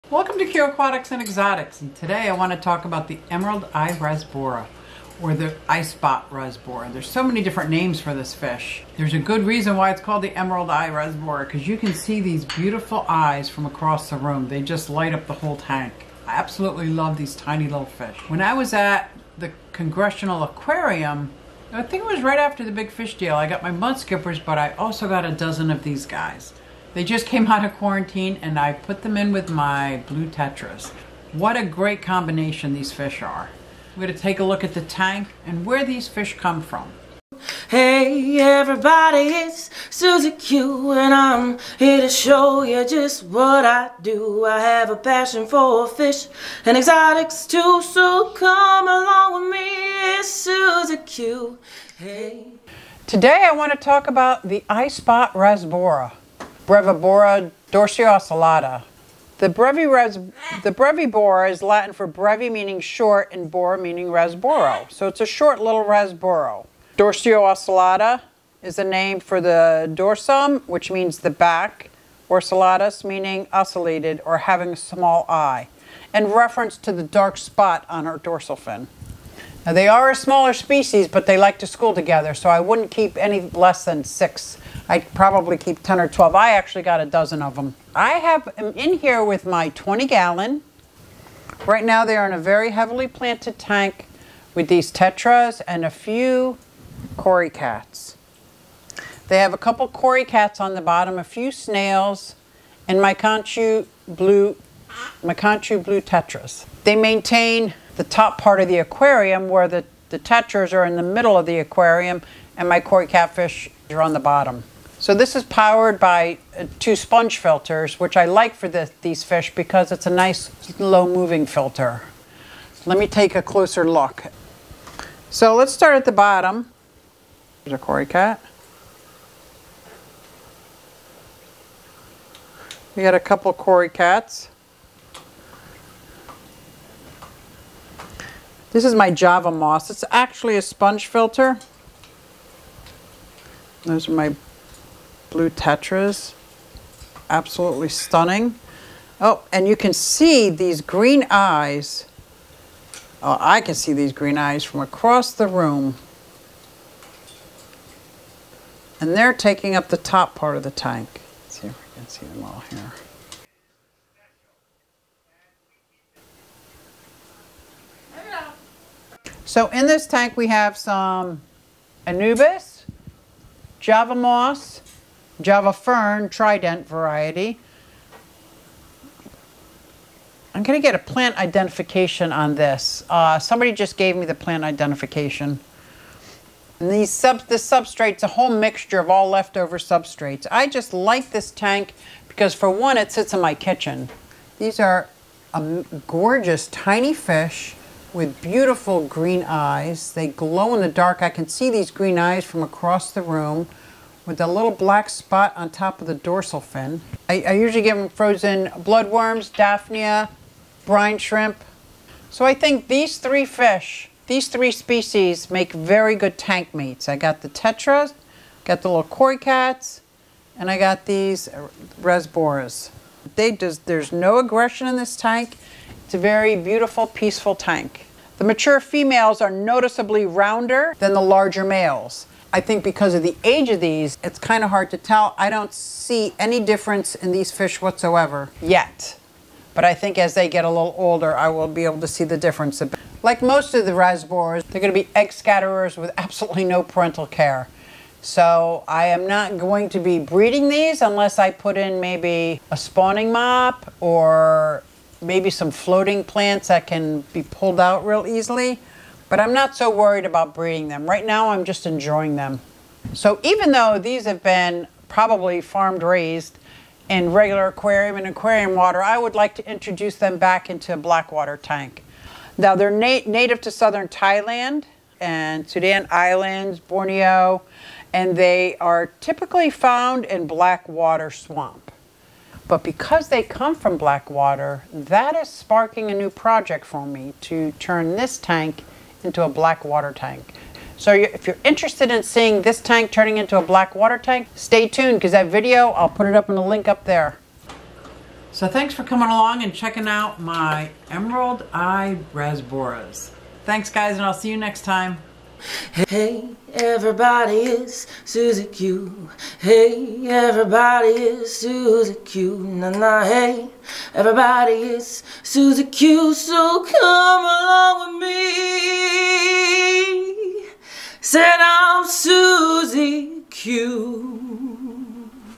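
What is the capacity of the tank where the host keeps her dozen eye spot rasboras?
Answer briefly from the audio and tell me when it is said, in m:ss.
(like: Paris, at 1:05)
20 gallons, at 1:29.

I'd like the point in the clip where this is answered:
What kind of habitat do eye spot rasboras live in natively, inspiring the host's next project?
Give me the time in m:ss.
4:40.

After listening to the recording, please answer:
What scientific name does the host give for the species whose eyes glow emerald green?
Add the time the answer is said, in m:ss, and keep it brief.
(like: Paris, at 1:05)
Brevibora dorsiocellata, at 0:56.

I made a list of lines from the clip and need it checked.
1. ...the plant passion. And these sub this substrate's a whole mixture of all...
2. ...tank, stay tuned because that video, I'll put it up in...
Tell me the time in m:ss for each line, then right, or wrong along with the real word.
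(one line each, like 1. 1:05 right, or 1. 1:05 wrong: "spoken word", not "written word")
1. 3:04 wrong: "identification", not "passion"
2. 4:54 right.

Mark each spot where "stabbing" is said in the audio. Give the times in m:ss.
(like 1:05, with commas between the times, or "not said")
not said.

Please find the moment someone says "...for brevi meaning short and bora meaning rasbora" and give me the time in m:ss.
1:01.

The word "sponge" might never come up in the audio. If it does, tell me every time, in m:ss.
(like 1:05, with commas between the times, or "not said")
1:56, 2:20.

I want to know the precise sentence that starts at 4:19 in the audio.
But I'm not so worried about breeding them.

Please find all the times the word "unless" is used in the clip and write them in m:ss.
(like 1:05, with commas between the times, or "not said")
4:11.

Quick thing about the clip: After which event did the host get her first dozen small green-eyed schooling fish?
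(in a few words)
the big fish deal.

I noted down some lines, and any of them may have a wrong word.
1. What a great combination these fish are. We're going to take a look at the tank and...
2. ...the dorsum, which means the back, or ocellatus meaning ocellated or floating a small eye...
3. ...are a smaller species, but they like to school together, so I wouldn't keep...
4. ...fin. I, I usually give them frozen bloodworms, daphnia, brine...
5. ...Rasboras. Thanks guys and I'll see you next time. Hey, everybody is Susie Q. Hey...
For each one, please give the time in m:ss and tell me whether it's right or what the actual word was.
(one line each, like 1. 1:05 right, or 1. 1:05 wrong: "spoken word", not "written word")
1. 0:31 right
2. 1:09 wrong: "having", not "floating"
3. 1:19 right
4. 3:26 right
5. 5:02 right.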